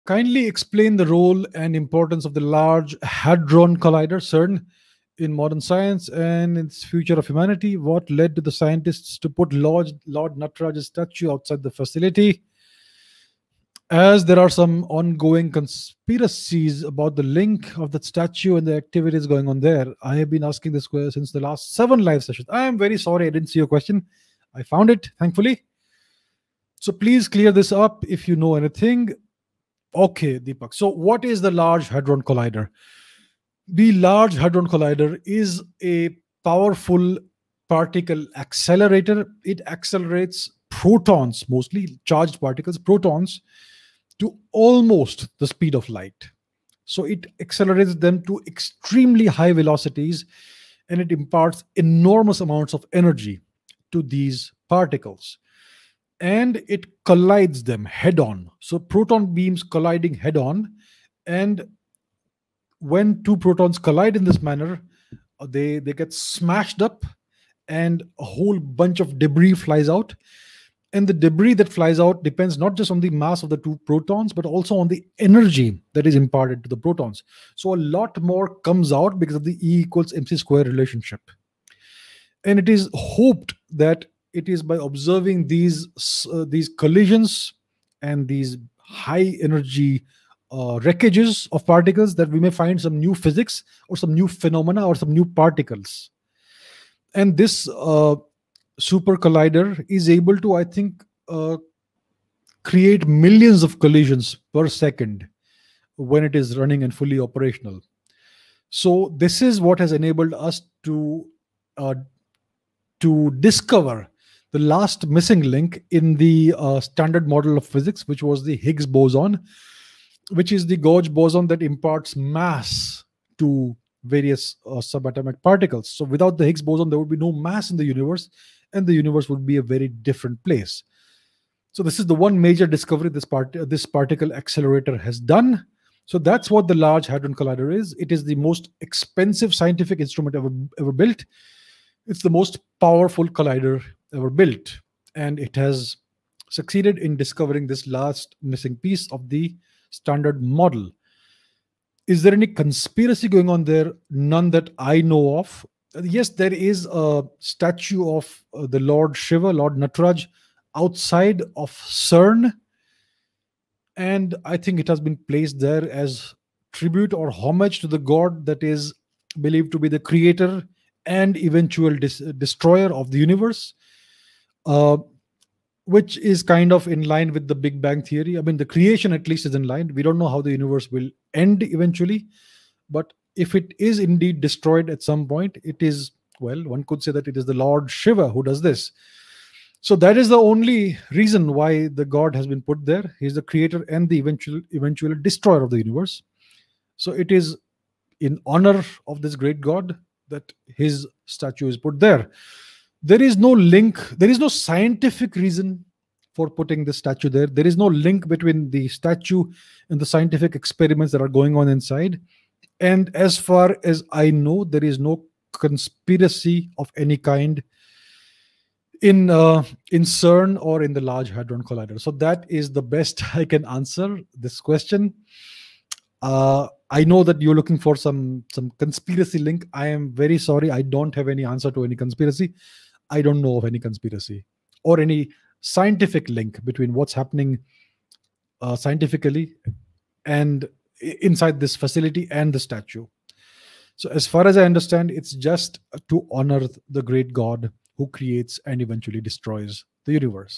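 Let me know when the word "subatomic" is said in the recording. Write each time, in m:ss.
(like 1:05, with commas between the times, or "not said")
2:04.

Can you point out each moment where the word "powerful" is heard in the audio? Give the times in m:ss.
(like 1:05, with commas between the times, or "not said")
0:36, 2:22.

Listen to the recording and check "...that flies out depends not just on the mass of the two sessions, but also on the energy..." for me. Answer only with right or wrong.
wrong.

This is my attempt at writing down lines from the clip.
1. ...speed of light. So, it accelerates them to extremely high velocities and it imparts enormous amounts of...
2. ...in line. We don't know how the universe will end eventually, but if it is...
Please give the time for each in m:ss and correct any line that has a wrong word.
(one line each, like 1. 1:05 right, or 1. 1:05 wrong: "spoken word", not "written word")
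1. 0:45 right
2. 2:59 right.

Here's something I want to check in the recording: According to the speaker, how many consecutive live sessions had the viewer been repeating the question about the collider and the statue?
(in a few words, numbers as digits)
7.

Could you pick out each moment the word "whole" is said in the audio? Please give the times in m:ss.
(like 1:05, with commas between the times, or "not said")
1:08.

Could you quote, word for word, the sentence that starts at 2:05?
So without the Higgs boson, there would be no mass in the universe, and the universe would be a very different place.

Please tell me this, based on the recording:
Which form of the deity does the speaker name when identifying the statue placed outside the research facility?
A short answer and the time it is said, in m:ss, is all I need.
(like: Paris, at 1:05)
Lord Nataraj, at 2:39.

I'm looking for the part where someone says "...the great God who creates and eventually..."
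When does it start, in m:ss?
4:06.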